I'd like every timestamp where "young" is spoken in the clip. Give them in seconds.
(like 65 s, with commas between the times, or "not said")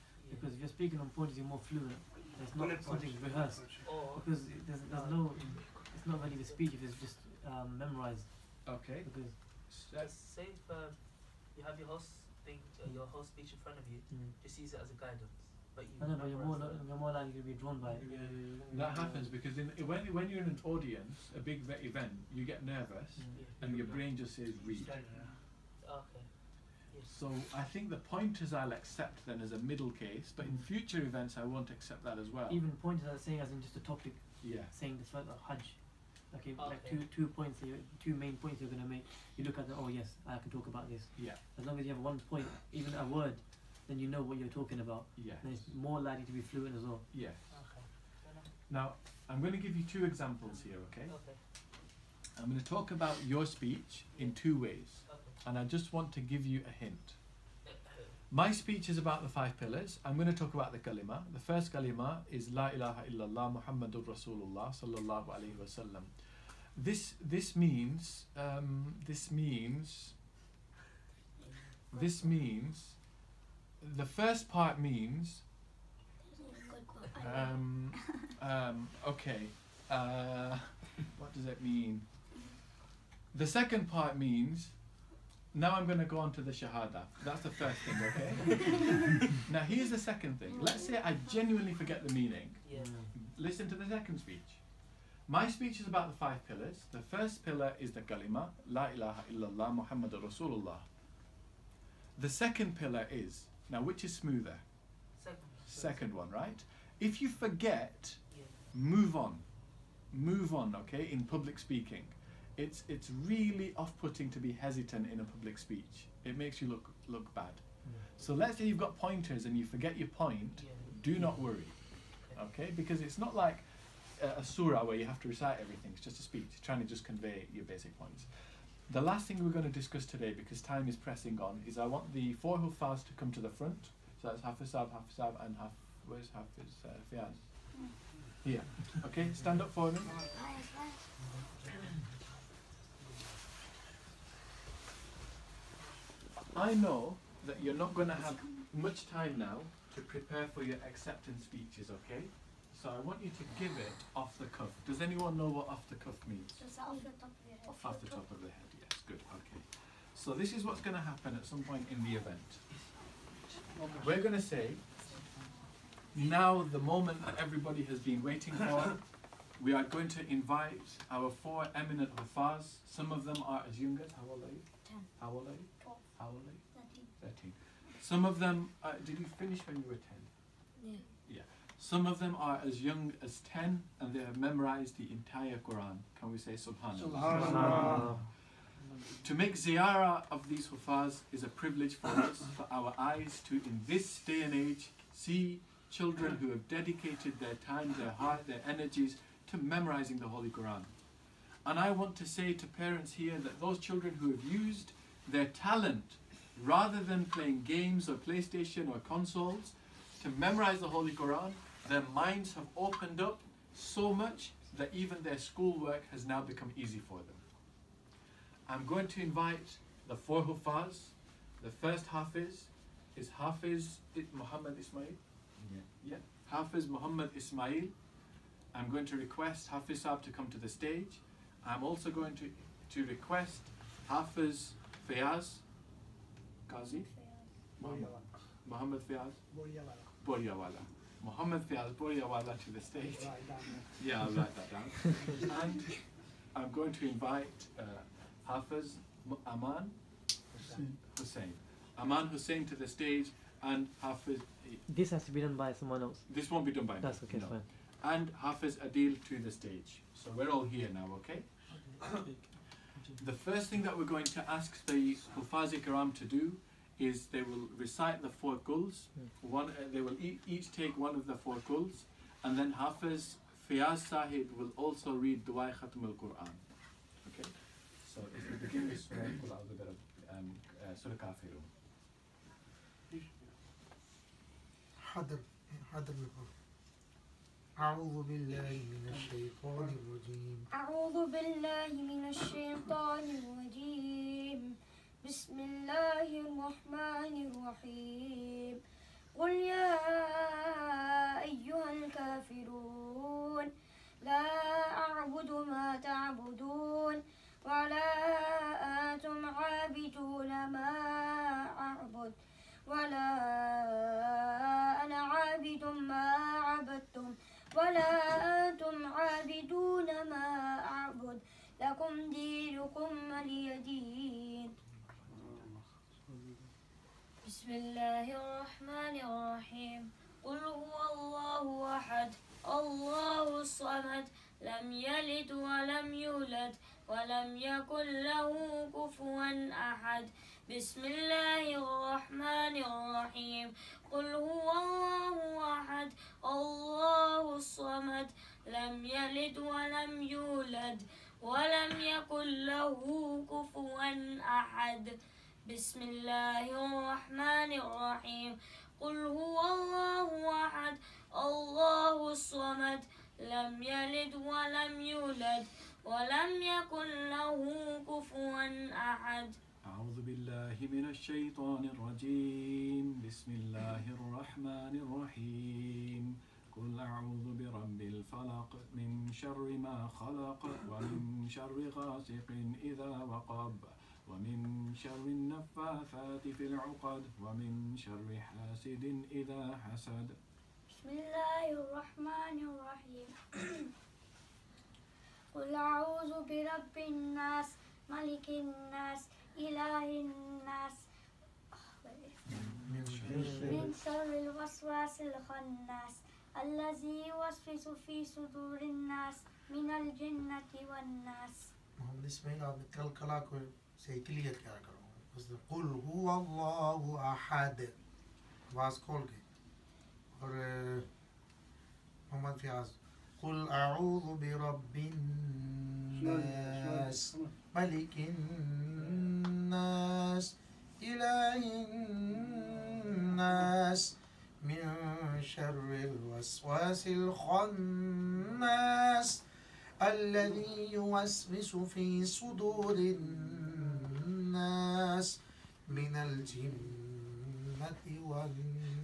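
173 s, 182 s.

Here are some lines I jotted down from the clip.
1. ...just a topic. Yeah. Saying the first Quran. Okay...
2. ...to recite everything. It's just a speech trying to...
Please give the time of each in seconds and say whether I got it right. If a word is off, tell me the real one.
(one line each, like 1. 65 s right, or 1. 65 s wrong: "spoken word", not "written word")
1. 33 s wrong: "Hajj", not "Quran"
2. 125 s right.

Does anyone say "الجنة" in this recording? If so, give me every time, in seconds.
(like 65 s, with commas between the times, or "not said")
409 s, 446 s.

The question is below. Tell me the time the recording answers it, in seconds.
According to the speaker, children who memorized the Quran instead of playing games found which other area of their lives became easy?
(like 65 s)
215 s.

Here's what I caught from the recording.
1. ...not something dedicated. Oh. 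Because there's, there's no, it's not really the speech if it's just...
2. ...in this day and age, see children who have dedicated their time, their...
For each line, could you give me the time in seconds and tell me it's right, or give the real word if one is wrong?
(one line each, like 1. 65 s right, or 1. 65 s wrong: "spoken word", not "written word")
1. 2 s wrong: "rehearsed", not "dedicated"
2. 193 s right.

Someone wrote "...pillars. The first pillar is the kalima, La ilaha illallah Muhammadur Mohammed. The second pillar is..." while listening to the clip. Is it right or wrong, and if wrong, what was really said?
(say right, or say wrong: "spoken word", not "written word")
wrong: "Rasulullah", not "Mohammed".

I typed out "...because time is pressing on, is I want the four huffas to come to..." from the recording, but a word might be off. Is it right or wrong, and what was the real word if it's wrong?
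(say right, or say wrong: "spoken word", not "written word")
right.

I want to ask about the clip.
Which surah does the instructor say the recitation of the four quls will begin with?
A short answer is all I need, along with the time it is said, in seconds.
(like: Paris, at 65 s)
Surah Kafirun, at 281 s.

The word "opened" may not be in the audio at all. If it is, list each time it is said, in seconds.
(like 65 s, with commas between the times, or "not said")
212 s.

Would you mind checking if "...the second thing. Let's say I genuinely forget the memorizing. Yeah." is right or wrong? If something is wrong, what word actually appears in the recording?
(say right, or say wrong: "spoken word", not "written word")
wrong: "meaning", not "memorizing".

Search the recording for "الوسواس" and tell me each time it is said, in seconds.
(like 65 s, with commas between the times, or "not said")
404 s, 435 s.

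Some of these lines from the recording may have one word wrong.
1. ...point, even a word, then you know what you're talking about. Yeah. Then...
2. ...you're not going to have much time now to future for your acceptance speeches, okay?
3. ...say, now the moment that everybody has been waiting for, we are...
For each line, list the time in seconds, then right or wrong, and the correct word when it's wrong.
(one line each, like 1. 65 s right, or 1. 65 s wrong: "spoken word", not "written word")
1. 42 s right
2. 147 s wrong: "prepare", not "future"
3. 164 s right.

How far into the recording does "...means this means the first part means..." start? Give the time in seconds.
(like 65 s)
69 s.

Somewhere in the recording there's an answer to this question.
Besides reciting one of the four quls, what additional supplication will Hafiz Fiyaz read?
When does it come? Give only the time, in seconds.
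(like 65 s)
275 s.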